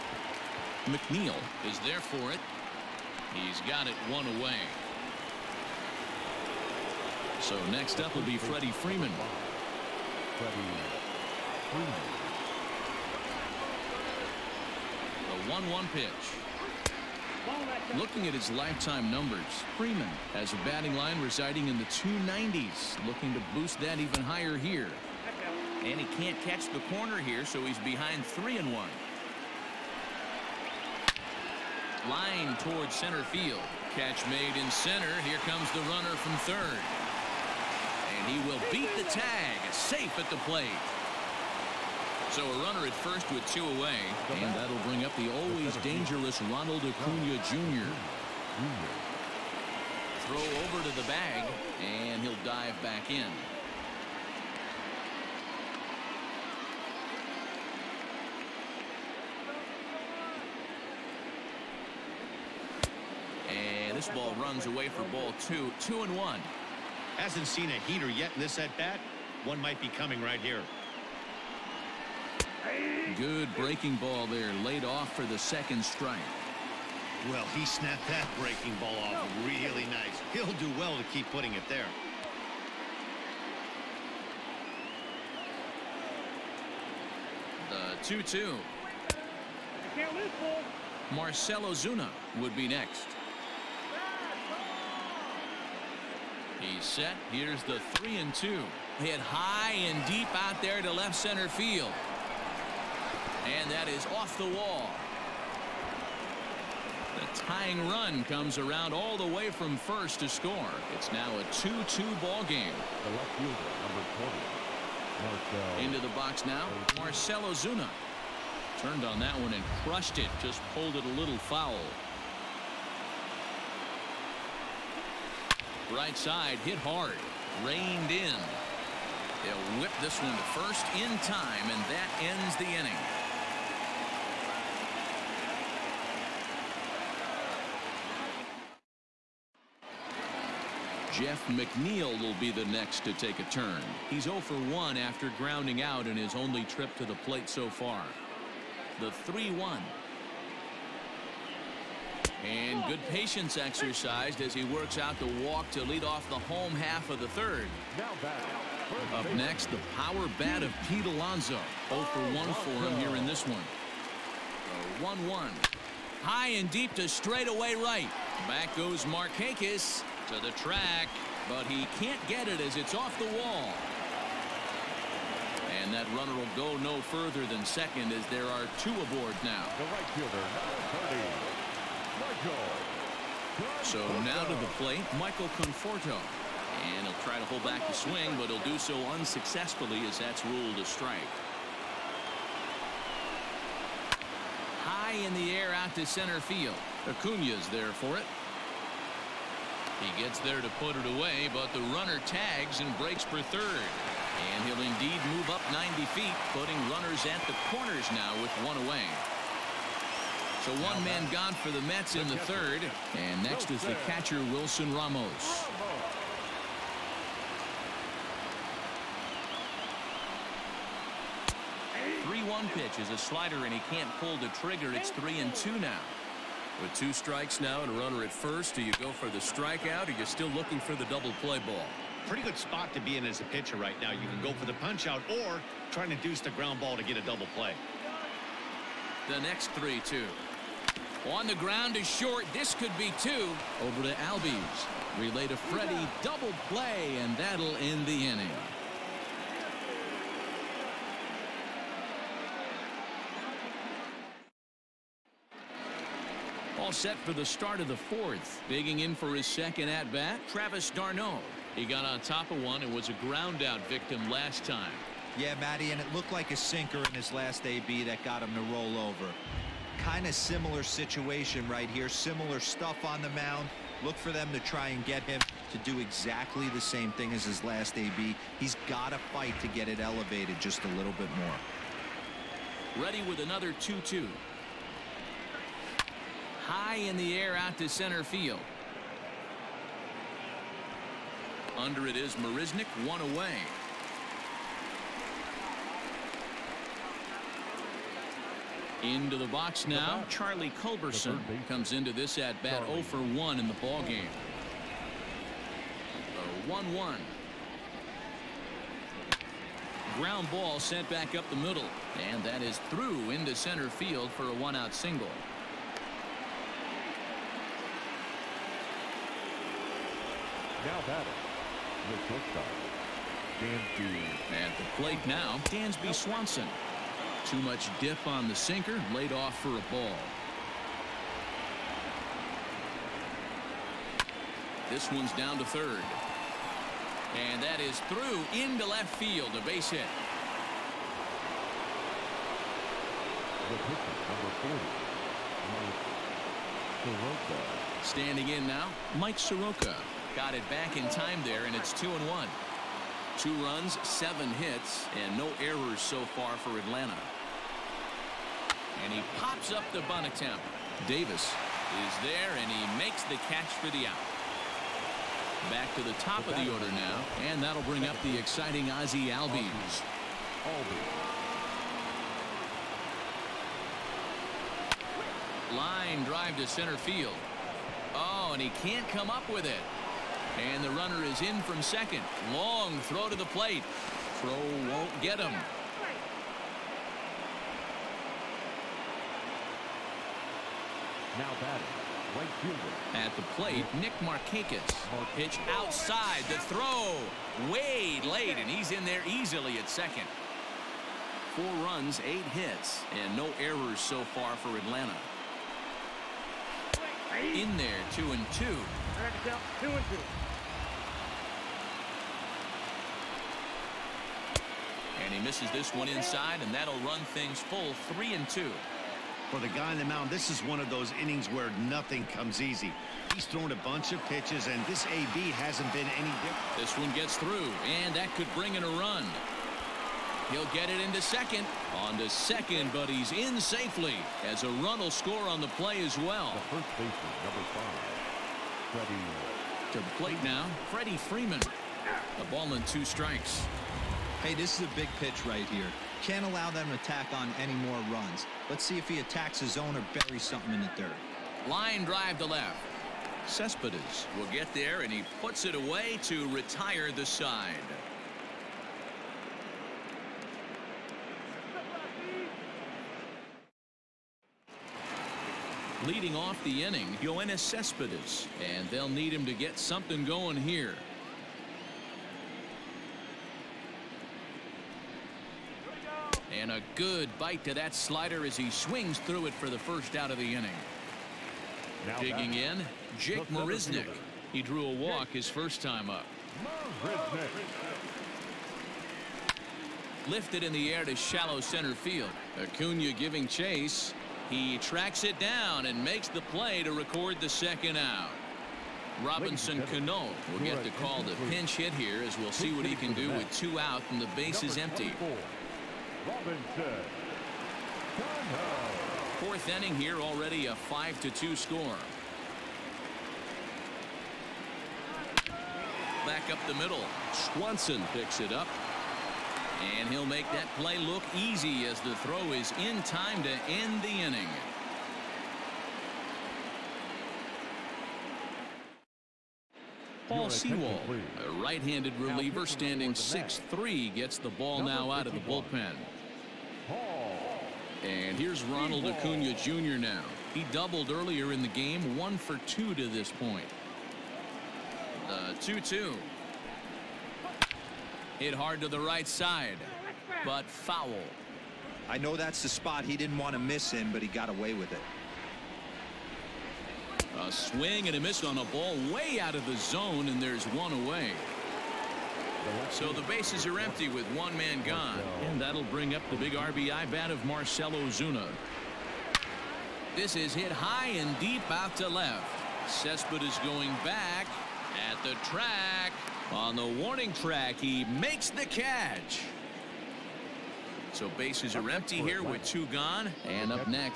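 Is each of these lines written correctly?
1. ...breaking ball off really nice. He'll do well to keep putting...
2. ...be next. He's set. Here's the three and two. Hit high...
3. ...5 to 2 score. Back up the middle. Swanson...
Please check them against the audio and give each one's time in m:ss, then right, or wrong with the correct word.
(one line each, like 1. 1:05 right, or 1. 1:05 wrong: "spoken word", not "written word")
1. 1:18 right
2. 1:32 right
3. 8:30 right.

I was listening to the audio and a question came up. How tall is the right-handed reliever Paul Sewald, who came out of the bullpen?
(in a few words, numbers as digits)
6-3.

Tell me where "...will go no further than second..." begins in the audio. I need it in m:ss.
2:56.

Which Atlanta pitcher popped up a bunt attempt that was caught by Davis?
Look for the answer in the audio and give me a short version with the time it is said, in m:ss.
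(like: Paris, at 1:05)
Mike Soroka, at 5:49.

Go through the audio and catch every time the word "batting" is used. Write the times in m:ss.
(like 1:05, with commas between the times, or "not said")
0:20, 5:21, 6:31.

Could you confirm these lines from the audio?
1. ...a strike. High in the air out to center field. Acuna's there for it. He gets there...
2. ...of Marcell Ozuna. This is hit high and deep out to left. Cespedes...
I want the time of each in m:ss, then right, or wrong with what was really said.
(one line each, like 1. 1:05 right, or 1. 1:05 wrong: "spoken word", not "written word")
1. 3:10 right
2. 9:27 right.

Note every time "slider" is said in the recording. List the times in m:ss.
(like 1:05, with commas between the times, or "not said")
3:43, 7:57.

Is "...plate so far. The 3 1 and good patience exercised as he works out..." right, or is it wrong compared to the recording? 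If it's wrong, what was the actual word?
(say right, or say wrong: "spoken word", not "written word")
right.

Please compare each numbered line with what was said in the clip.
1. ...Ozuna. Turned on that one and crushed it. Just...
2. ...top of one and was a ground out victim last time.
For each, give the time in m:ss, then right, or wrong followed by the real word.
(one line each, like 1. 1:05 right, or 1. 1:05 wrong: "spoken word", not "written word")
1. 1:57 right
2. 4:22 right.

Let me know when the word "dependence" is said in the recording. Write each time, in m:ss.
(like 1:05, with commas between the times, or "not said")
not said.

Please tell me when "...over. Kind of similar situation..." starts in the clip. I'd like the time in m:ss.
4:28.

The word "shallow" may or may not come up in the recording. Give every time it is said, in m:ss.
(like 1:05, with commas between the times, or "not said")
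8:11.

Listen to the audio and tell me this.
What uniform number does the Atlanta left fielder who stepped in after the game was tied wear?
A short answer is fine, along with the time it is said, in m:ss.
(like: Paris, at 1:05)
20, at 1:53.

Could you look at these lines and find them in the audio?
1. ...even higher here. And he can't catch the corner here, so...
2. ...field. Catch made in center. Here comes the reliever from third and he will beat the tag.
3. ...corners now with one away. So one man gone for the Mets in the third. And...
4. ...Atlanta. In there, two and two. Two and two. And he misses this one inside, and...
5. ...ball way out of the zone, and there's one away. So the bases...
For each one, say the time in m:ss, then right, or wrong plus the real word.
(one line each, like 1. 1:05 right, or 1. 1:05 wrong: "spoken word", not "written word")
1. 0:23 right
2. 0:33 wrong: "runner", not "reliever"
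3. 3:27 right
4. 6:44 right
5. 9:18 right.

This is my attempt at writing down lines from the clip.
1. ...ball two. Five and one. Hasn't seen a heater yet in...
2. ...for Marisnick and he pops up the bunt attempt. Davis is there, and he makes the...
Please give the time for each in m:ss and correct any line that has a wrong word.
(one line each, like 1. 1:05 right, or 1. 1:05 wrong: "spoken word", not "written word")
1. 1:05 wrong: "Two", not "Five"
2. 5:56 wrong: "Atlanta", not "Marisnick".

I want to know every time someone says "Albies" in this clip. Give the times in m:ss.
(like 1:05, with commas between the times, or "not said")
4:04, 6:09.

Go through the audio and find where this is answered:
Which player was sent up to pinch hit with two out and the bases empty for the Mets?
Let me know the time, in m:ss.
8:19.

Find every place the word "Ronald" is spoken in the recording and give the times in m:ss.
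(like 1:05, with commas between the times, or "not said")
0:46, 8:58.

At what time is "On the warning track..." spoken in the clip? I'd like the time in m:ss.
9:36.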